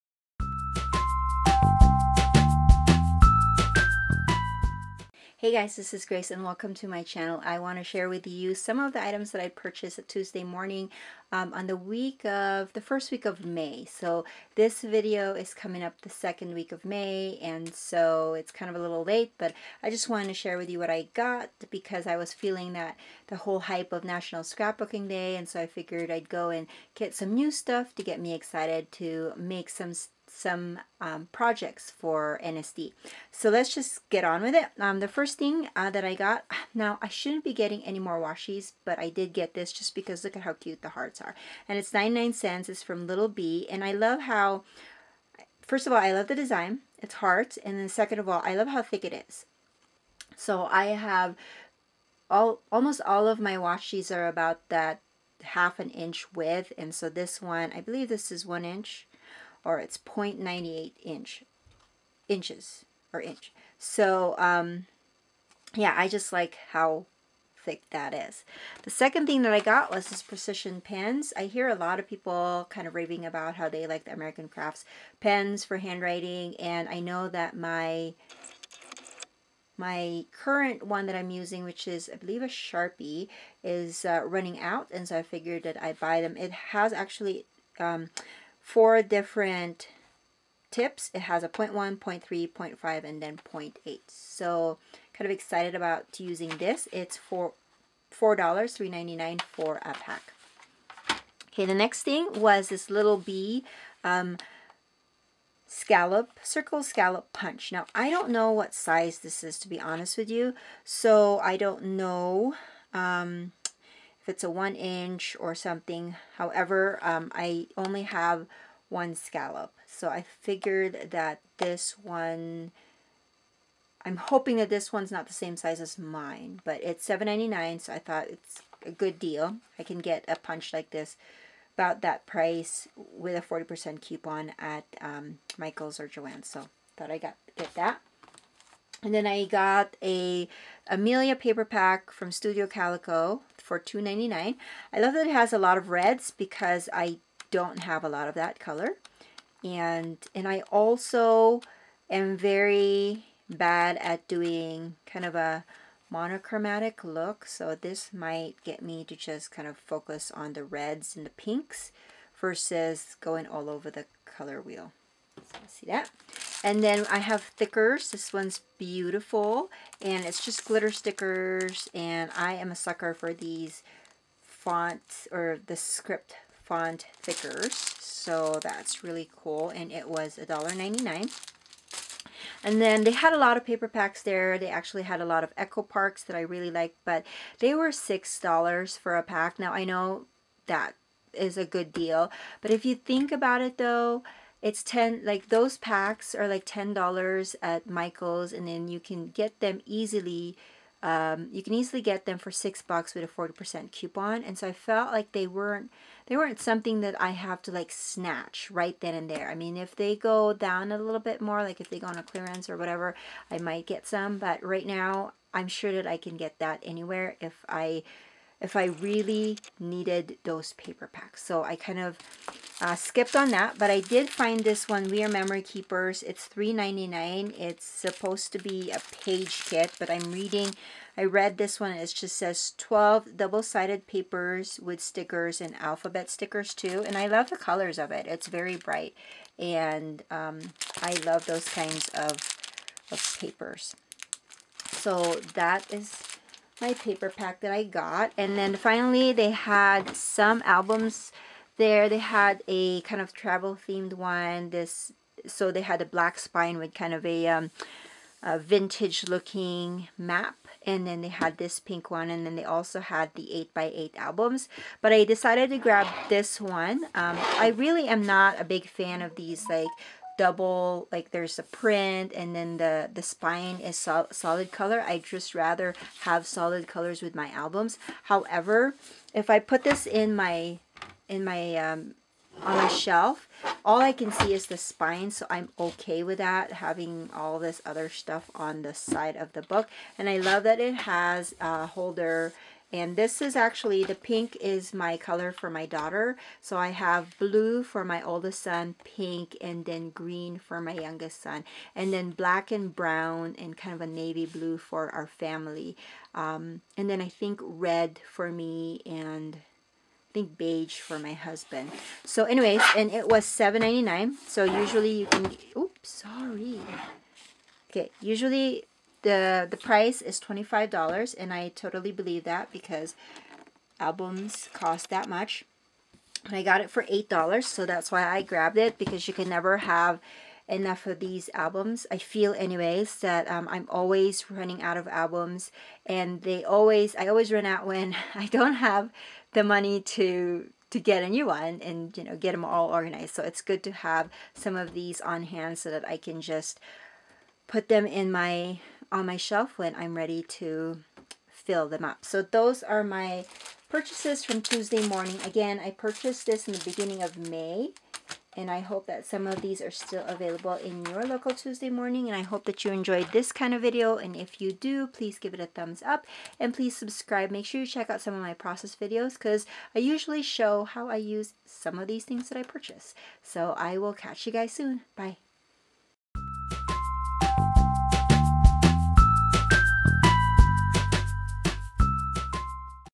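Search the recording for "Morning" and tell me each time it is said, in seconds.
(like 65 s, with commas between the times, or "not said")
10 s, 355 s, 361 s.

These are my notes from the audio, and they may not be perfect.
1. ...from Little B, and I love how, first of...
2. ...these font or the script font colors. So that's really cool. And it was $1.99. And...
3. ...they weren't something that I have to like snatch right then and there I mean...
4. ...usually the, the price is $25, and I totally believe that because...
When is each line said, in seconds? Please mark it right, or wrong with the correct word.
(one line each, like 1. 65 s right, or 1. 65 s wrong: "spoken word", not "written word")
1. 42 s right
2. 173 s wrong: "thickers", not "colors"
3. 206 s right
4. 318 s right.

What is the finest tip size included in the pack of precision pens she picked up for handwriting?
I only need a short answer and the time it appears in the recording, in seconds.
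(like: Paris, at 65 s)
0.1, at 91 s.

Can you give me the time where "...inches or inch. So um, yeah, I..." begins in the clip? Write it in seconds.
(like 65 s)
62 s.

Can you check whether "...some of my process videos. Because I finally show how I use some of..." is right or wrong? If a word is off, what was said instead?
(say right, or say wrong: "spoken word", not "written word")
wrong: "usually", not "finally".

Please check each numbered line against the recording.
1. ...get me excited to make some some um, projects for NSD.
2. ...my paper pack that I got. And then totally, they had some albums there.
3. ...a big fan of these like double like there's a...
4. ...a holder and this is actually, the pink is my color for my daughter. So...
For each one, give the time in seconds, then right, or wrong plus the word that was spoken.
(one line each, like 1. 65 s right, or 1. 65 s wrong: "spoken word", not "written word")
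1. 28 s right
2. 246 s wrong: "finally", not "totally"
3. 268 s right
4. 291 s right.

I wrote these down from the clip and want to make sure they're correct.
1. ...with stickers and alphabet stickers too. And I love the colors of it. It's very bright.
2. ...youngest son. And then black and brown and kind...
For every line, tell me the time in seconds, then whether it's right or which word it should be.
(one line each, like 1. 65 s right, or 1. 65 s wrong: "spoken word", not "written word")
1. 234 s right
2. 300 s right.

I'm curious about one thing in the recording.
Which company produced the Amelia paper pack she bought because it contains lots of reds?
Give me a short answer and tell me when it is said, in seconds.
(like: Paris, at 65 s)
Studio Calico, at 142 s.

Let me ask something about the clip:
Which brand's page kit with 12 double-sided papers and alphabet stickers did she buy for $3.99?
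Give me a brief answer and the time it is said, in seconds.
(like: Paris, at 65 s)
We Are Memory Keepers, at 225 s.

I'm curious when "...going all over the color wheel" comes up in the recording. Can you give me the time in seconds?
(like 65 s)
163 s.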